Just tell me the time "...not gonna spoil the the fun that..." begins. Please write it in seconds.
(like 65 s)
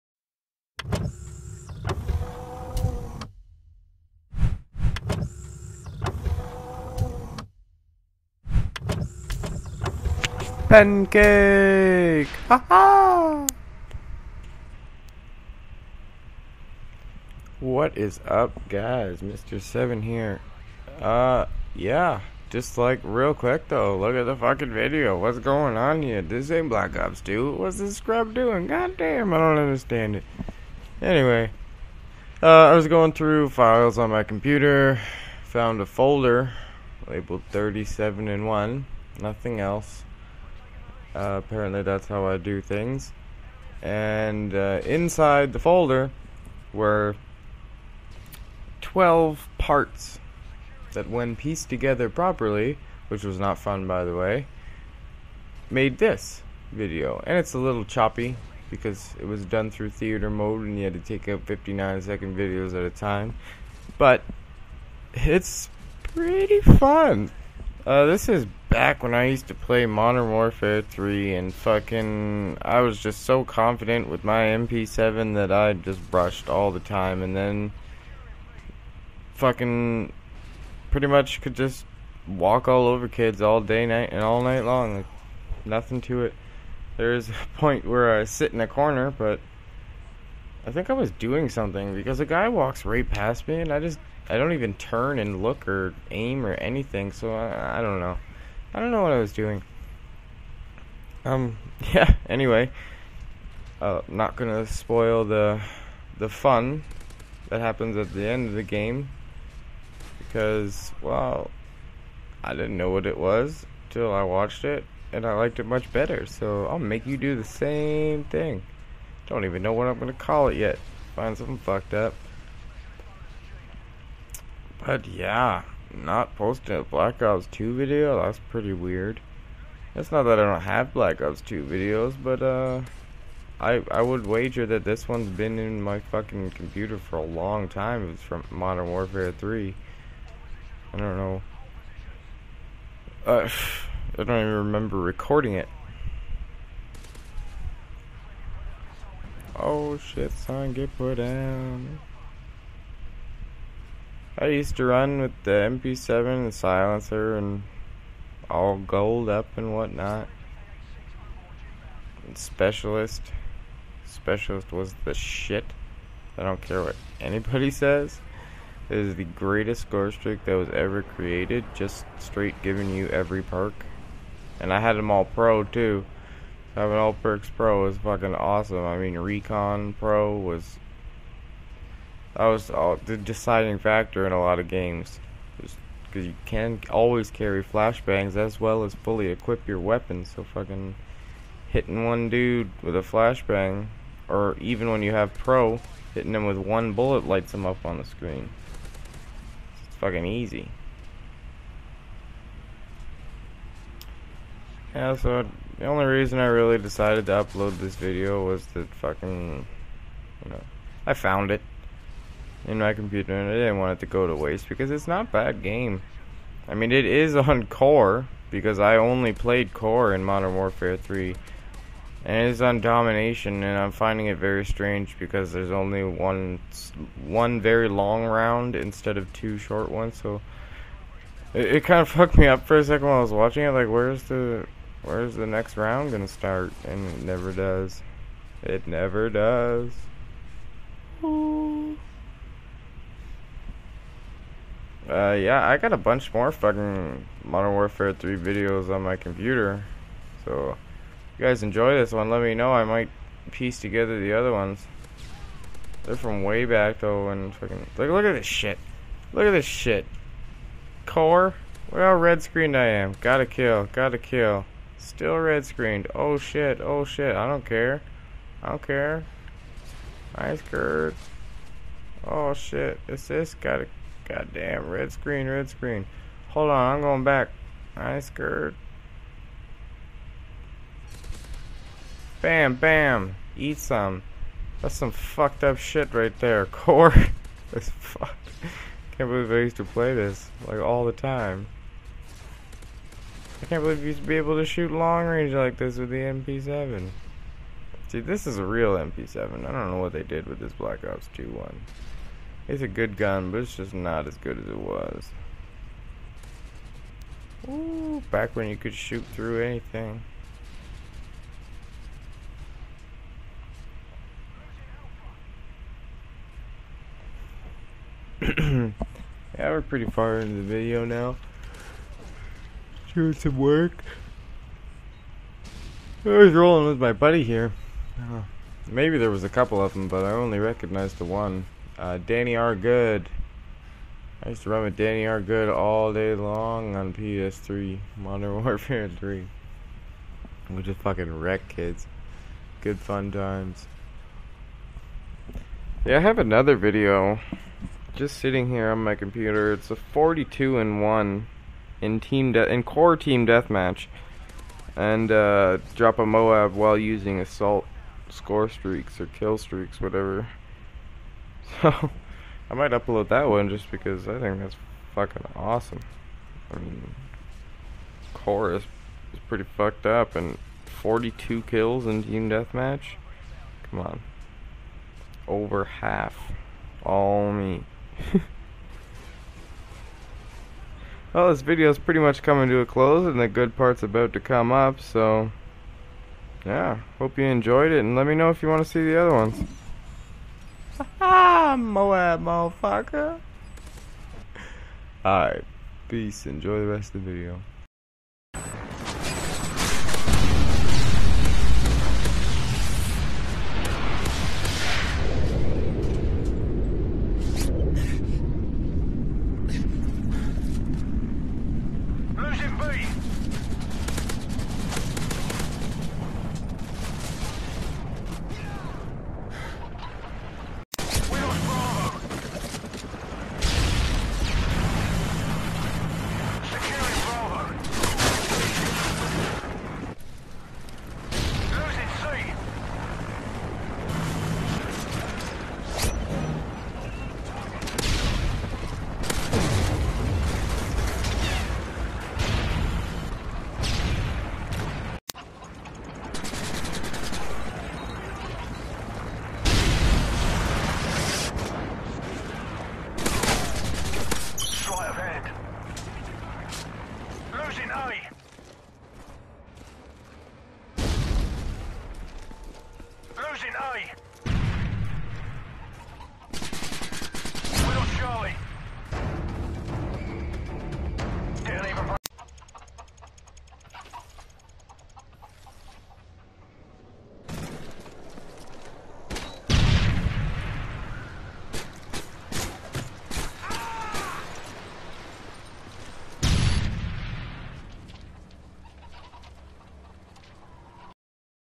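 104 s.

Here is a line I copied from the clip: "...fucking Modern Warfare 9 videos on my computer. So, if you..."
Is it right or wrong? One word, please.
wrong.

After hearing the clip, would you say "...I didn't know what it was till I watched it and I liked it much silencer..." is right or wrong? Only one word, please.
wrong.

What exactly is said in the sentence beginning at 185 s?
Because you can always carry flashbangs as well as fully equip your weapons.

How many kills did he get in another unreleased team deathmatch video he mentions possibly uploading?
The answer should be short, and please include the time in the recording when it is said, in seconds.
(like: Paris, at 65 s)
42, at 349 s.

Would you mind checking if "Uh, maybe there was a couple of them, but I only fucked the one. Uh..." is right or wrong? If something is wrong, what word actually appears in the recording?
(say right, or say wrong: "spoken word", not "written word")
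wrong: "recognized", not "fucked".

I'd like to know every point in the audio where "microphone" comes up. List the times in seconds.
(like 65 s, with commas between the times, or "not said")
not said.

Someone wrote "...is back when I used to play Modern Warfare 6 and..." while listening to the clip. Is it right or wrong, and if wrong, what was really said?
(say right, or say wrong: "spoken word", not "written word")
wrong: "3", not "6".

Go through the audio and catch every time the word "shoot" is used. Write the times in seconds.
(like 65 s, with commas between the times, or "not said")
294 s, 308 s.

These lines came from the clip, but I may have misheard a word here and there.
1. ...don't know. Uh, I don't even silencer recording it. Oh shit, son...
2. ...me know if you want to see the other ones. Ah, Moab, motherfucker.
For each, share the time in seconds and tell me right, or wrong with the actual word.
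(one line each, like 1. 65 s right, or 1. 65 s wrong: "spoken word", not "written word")
1. 140 s wrong: "remember", not "silencer"
2. 388 s right.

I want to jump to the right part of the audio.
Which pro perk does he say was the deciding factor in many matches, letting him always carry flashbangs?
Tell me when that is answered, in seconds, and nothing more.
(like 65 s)
179 s.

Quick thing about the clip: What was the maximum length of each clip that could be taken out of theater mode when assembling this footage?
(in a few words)
59 seconds.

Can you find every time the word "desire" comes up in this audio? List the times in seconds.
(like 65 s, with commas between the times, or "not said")
not said.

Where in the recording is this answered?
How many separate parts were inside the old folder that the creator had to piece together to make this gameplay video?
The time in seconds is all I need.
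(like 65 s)
48 s.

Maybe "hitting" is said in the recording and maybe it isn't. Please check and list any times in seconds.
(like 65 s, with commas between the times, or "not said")
191 s, 196 s.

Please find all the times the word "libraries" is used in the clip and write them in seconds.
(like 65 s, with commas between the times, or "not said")
not said.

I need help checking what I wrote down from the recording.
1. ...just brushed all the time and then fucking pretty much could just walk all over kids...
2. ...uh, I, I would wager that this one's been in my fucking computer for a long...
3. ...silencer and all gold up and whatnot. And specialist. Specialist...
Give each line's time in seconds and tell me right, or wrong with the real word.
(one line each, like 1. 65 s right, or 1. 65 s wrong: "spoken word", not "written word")
1. 75 s right
2. 132 s right
3. 156 s right.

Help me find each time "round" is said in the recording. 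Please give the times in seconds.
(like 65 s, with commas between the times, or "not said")
228 s, 235 s.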